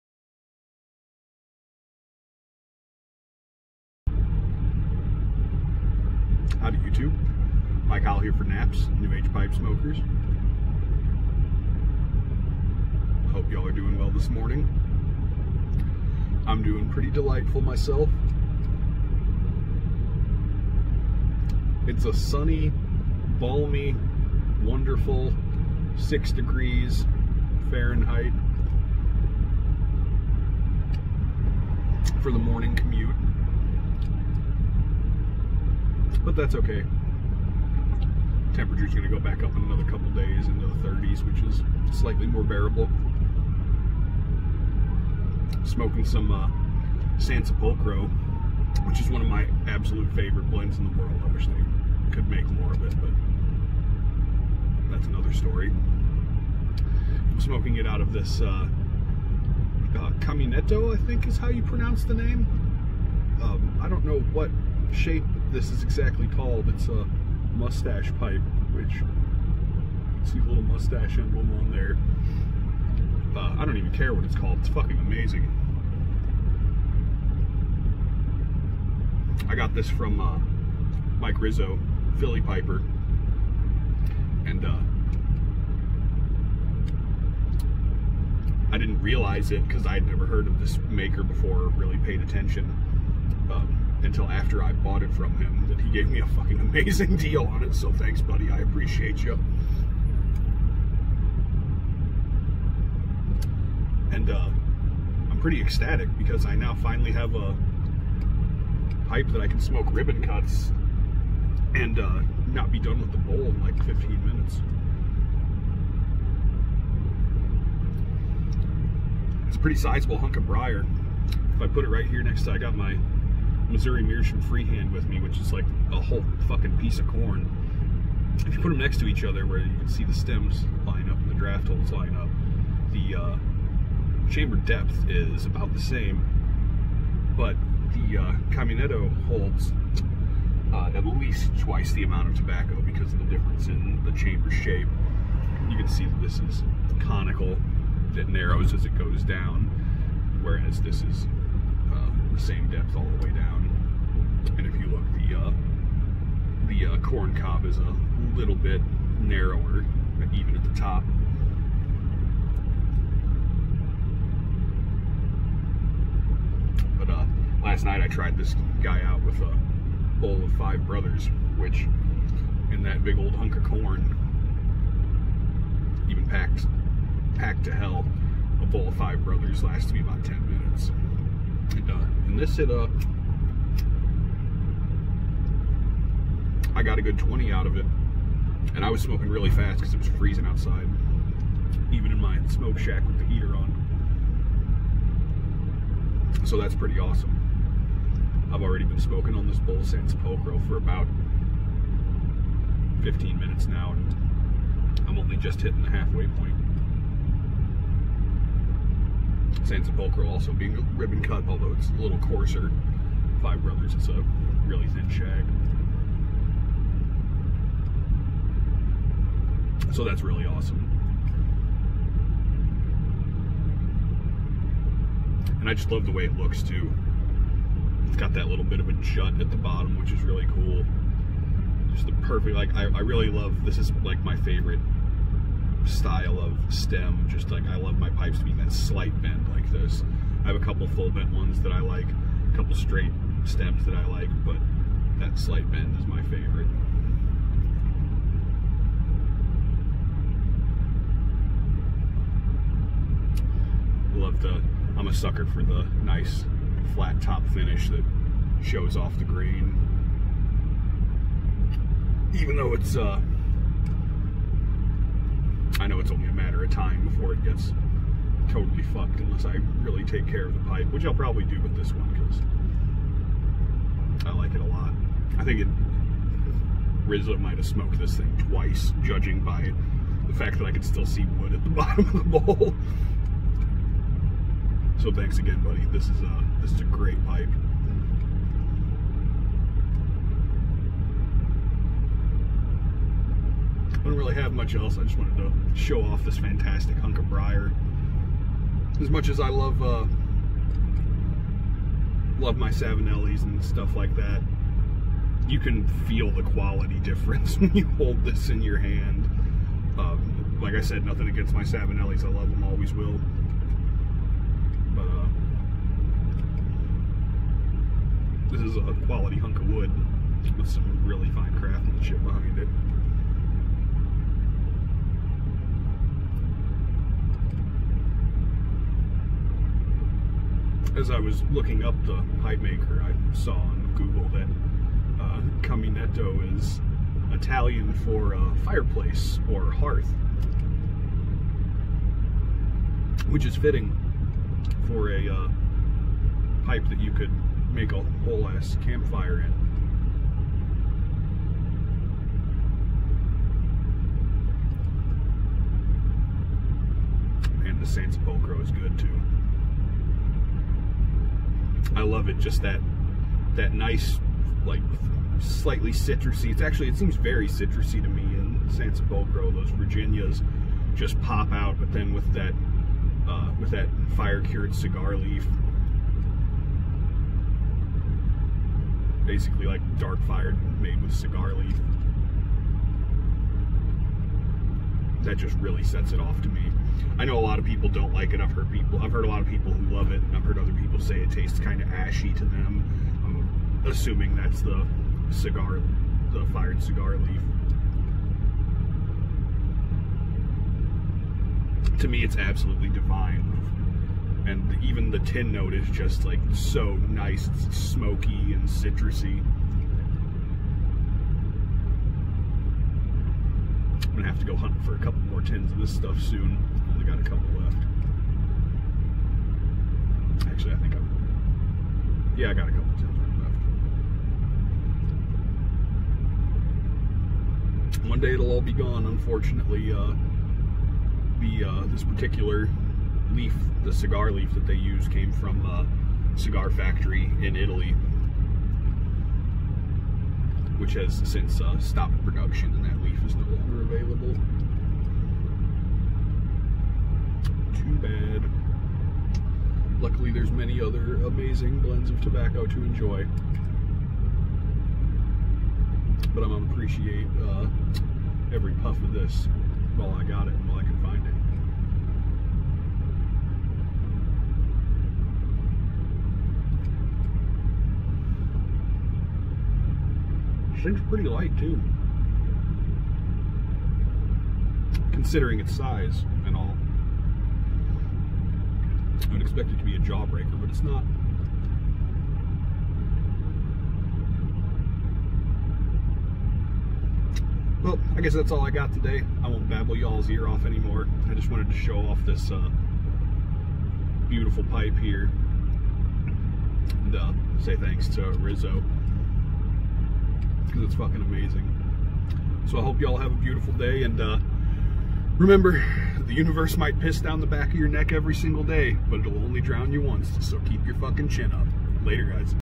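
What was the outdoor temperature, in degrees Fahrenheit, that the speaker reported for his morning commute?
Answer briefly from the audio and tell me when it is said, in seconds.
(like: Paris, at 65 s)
6, at 25 s.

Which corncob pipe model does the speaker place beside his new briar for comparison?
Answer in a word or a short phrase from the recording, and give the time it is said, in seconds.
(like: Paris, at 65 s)
Missouri Meerschaum Freehand, at 123 s.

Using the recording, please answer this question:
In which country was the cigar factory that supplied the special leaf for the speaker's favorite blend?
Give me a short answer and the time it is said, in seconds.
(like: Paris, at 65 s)
Italy, at 437 s.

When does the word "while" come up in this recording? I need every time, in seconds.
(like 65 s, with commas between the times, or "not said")
459 s.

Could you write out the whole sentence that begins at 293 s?
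I don't really have much else.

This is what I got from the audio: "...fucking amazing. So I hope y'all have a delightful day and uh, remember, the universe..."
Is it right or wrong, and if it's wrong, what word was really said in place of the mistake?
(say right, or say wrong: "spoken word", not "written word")
wrong: "beautiful", not "delightful".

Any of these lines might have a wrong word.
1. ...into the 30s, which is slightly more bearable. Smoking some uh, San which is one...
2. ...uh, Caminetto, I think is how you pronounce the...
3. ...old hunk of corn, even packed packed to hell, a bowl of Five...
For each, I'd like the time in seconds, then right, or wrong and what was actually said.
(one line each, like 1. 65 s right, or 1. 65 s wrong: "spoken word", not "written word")
1. 40 s right
2. 59 s right
3. 173 s right.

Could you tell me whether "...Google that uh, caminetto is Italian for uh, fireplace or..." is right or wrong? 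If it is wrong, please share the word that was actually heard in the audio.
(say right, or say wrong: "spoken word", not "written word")
right.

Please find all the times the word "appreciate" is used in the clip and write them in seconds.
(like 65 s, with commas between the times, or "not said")
98 s, 456 s.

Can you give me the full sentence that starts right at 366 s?
It's actually it seems very citrusy to me in Sansepolcro.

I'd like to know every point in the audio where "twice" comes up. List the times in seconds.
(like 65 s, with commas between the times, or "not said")
141 s, 278 s.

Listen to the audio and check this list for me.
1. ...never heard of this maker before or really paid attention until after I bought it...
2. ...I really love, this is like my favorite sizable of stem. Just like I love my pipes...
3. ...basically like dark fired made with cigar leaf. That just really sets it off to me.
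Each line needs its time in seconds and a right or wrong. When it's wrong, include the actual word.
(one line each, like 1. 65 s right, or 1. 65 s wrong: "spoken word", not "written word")
1. 90 s right
2. 232 s wrong: "style", not "sizable"
3. 379 s right.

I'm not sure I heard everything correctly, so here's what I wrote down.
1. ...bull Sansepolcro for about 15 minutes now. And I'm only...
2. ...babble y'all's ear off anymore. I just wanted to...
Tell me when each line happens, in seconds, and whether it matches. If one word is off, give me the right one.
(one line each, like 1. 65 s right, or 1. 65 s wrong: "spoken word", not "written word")
1. 199 s right
2. 489 s right.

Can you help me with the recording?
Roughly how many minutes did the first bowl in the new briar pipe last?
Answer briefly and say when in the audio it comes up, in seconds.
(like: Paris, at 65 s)
20, at 186 s.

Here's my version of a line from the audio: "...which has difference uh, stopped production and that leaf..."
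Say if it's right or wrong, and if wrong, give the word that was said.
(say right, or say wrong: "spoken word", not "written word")
wrong: "since", not "difference".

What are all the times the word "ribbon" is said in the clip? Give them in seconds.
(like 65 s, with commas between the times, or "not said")
109 s, 210 s.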